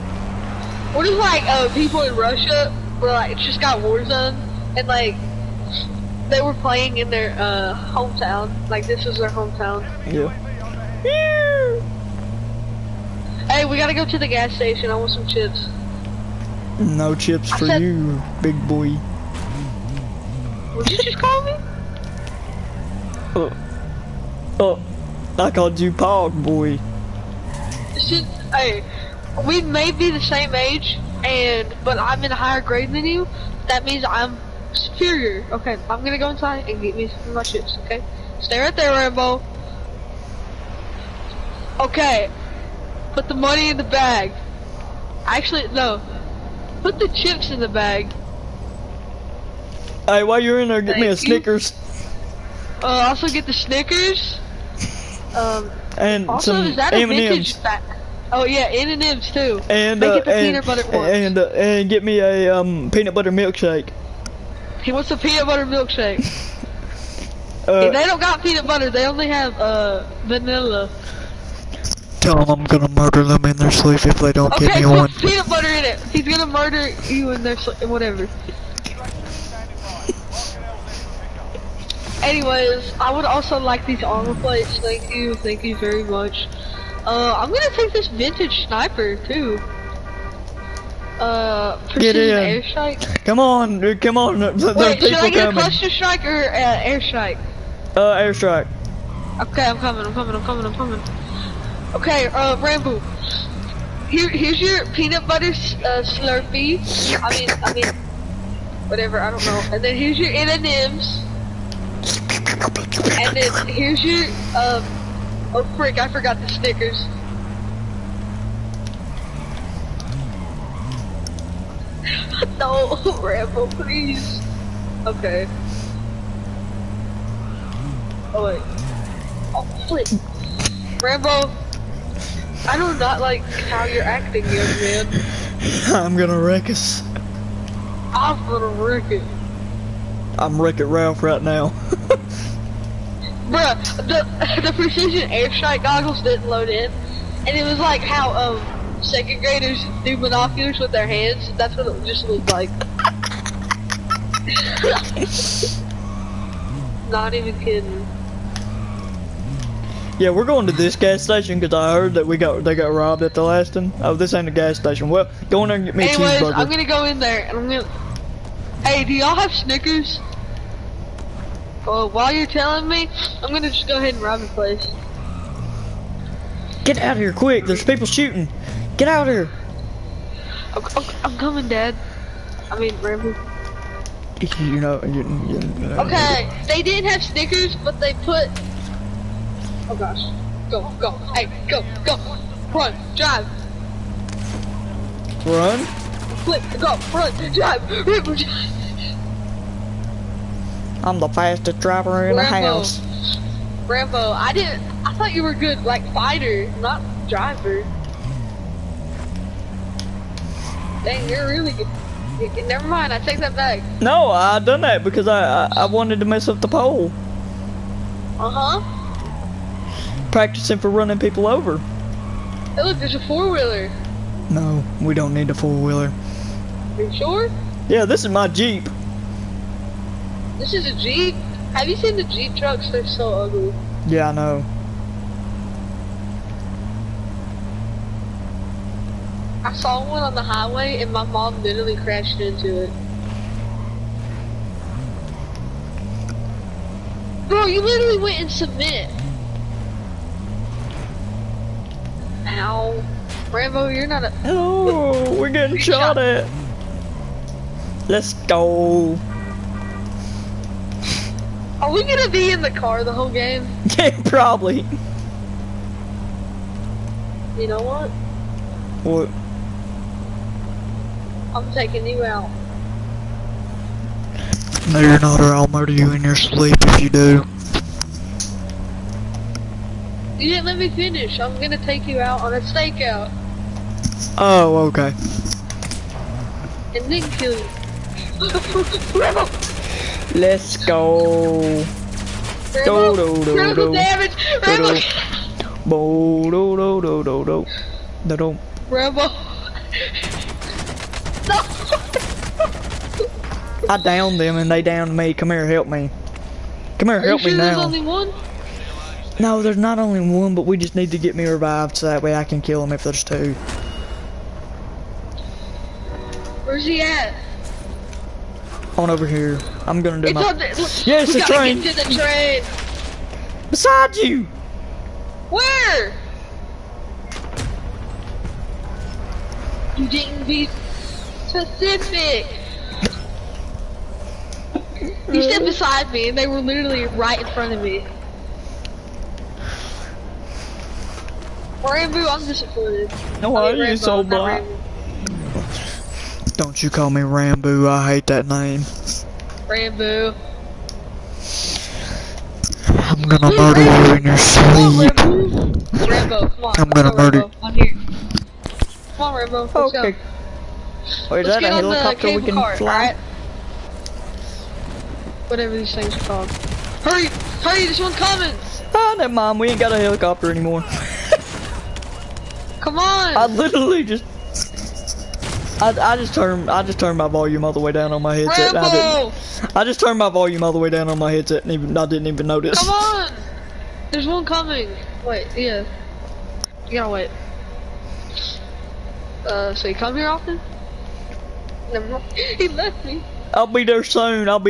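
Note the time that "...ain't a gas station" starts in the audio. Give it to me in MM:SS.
02:44.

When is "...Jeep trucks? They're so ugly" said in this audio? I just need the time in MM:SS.
03:52.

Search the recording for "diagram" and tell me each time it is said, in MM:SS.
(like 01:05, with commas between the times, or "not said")
not said.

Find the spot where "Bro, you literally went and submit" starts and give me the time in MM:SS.
04:07.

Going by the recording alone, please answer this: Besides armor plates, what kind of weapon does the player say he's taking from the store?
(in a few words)
Vintage sniper.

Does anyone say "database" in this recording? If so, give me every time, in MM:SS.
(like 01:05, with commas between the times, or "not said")
not said.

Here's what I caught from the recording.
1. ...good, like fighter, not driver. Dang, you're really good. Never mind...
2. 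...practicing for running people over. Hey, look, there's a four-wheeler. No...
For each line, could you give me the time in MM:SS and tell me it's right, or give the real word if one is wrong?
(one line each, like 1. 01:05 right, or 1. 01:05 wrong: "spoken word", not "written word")
1. 03:25 right
2. 03:40 right.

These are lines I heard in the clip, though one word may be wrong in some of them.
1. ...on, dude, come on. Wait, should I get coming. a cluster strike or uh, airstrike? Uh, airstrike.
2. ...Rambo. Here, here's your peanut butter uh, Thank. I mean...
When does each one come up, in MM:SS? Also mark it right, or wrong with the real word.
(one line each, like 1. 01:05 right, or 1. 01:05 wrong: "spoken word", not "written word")
1. 01:33 right
2. 01:42 wrong: "Slurpee", not "Thank".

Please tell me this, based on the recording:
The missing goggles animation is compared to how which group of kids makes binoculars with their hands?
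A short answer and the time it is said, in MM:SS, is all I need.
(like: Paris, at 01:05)
Second graders, at 02:29.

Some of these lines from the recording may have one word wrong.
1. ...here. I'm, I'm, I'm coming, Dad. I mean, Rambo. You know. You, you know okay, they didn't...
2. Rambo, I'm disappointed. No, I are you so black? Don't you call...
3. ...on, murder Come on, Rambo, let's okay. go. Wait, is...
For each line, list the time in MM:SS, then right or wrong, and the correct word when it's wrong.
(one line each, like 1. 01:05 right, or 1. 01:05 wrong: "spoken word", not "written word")
1. 02:59 right
2. 05:41 right
3. 05:57 right.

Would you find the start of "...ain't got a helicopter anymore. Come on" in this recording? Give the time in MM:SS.
06:09.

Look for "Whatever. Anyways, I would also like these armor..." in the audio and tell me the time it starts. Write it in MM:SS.
01:17.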